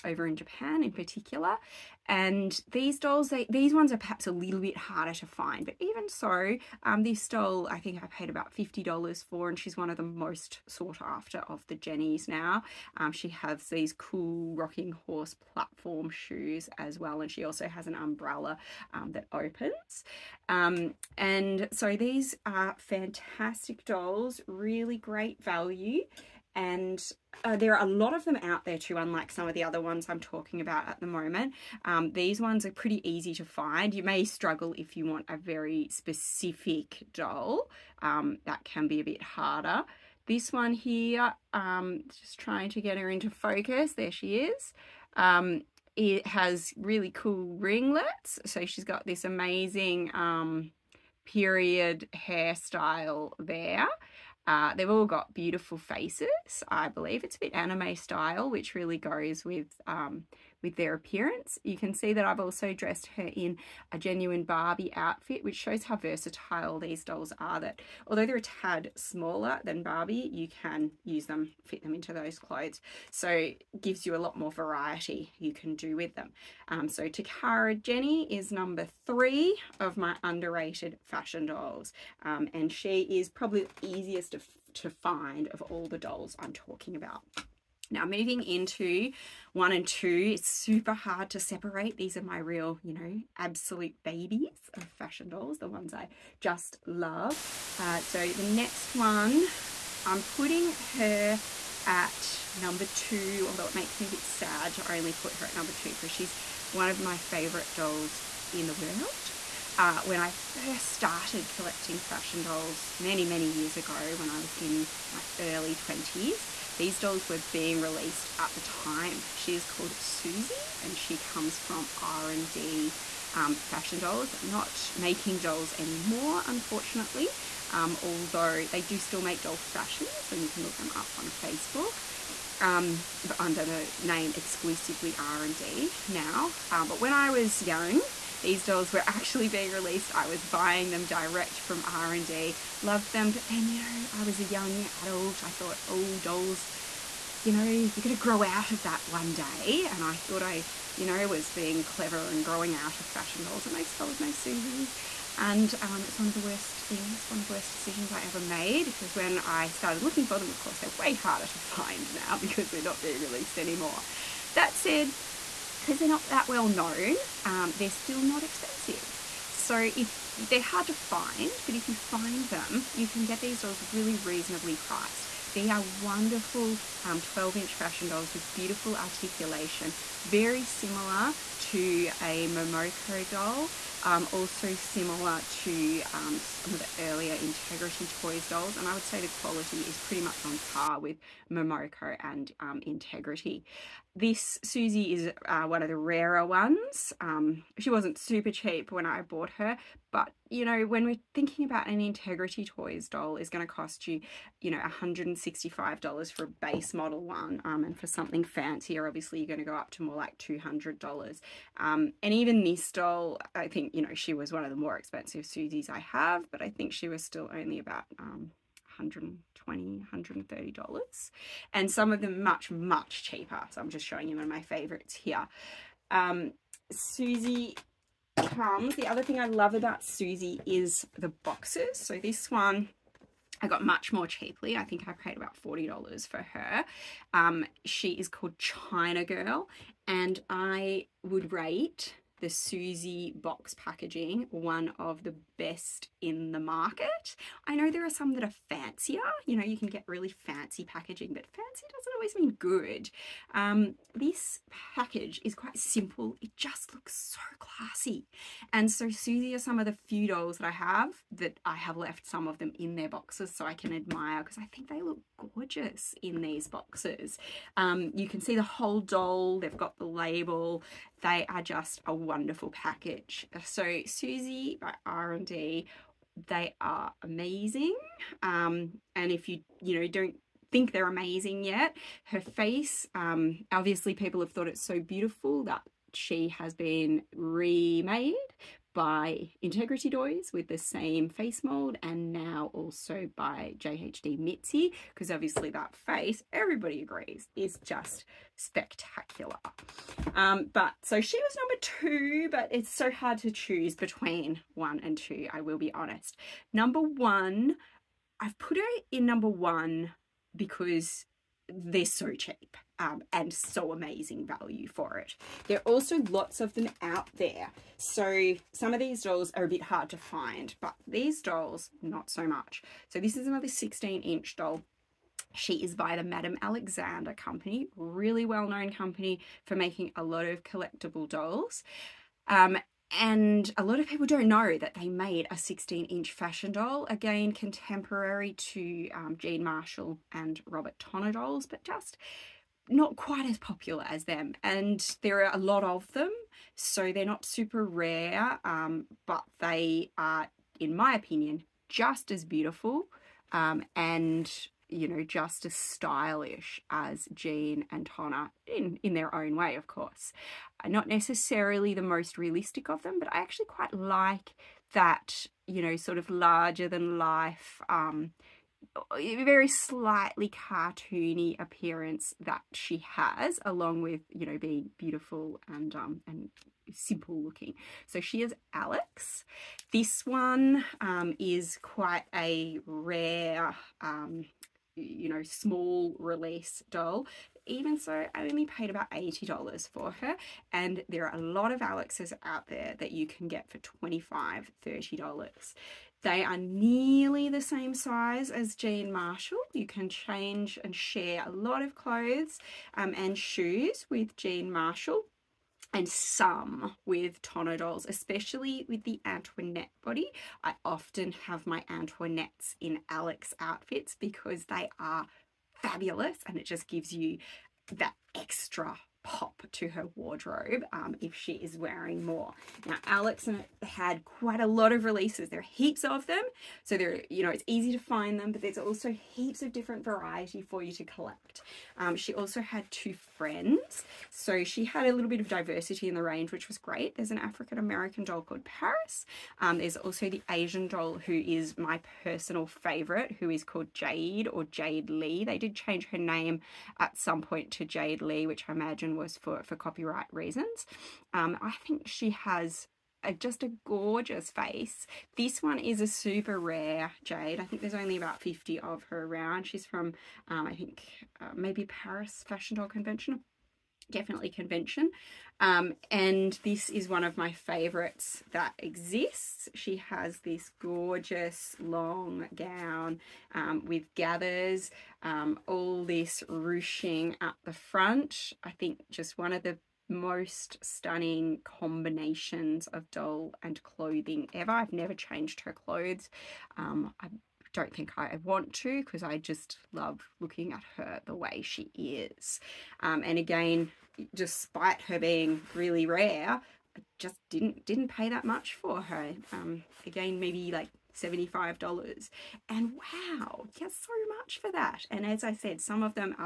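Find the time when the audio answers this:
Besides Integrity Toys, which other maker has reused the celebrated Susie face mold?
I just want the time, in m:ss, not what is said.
4:53.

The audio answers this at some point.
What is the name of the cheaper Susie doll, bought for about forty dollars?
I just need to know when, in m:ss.
3:58.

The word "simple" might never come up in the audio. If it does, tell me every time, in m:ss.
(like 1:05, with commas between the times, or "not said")
4:15, 6:16.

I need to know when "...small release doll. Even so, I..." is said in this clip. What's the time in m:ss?
6:25.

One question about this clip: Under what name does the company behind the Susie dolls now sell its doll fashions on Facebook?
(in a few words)
Exclusively R&D.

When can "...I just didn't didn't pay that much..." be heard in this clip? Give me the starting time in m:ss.
8:16.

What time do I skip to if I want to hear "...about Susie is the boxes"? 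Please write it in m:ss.
3:49.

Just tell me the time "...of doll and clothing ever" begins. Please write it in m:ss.
8:02.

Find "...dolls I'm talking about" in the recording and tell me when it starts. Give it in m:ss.
1:25.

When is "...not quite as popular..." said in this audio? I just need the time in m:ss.
5:42.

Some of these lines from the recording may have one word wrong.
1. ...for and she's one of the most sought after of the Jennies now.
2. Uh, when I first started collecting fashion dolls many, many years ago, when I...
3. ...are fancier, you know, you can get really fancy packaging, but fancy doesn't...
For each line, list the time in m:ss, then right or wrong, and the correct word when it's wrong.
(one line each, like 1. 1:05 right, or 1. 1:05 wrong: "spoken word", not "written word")
1. 0:09 right
2. 1:49 right
3. 4:08 right.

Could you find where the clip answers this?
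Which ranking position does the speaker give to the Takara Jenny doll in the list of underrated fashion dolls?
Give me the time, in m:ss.
1:18.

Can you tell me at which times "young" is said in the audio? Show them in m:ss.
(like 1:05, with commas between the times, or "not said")
2:17, 2:24.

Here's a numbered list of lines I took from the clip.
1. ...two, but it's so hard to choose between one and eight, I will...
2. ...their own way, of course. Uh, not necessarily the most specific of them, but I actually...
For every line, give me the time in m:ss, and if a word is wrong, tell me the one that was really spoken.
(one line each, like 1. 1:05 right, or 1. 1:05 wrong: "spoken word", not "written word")
1. 5:01 wrong: "two", not "eight"
2. 5:59 wrong: "realistic", not "specific".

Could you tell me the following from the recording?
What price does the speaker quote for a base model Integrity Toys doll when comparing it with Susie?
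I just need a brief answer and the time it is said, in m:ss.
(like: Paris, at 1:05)
$165, at 3:24.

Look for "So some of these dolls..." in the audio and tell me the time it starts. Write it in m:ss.
5:17.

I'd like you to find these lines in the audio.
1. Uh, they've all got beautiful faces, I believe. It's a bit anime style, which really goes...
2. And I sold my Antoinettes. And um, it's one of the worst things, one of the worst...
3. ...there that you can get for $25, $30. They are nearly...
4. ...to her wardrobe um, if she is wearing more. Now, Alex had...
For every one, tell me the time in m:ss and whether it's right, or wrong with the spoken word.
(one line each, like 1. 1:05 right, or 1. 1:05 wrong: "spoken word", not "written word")
1. 0:54 right
2. 2:33 wrong: "Susies", not "Antoinettes"
3. 6:32 right
4. 6:59 right.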